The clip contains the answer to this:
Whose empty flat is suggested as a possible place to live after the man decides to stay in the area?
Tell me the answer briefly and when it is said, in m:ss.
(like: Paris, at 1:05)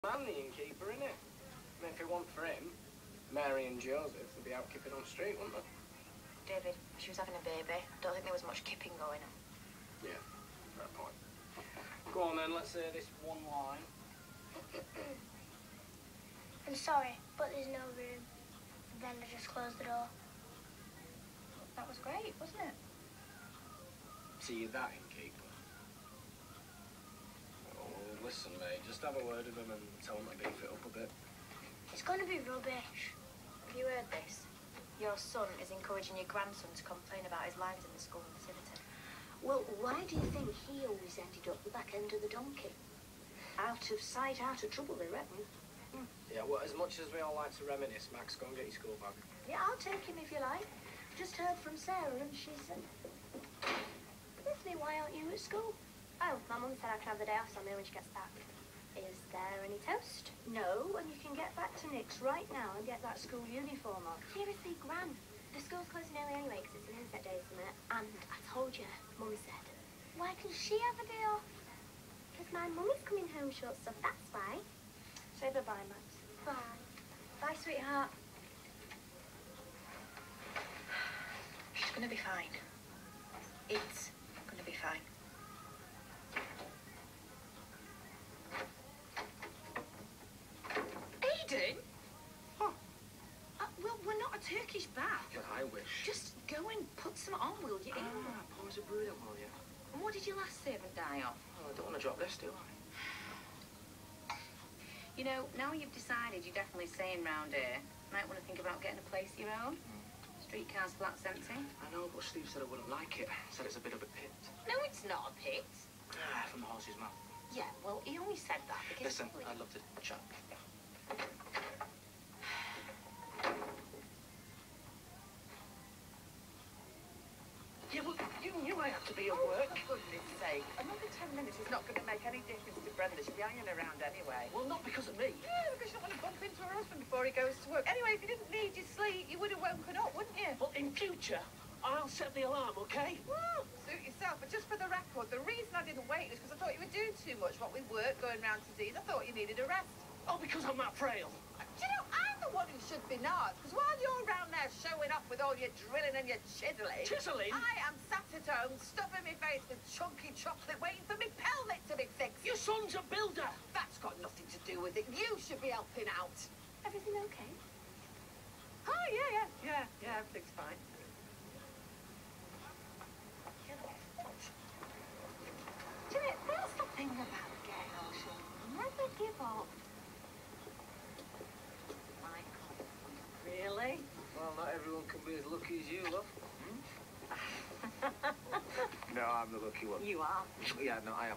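Streetcar's, at 1:50.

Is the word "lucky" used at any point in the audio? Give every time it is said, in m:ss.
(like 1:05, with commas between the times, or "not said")
3:05, 3:09.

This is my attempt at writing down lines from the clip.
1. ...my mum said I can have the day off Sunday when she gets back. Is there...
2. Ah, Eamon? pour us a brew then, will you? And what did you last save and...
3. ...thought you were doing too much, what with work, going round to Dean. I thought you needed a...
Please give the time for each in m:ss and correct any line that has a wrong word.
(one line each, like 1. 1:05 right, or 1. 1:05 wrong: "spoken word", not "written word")
1. 0:56 right
2. 1:37 right
3. 2:26 right.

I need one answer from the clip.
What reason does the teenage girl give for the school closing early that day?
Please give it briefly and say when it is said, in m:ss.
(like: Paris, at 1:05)
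Inset day, at 1:07.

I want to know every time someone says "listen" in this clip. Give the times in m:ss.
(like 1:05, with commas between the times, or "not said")
0:28, 1:59.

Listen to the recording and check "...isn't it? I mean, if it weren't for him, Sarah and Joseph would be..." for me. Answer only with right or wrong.
wrong.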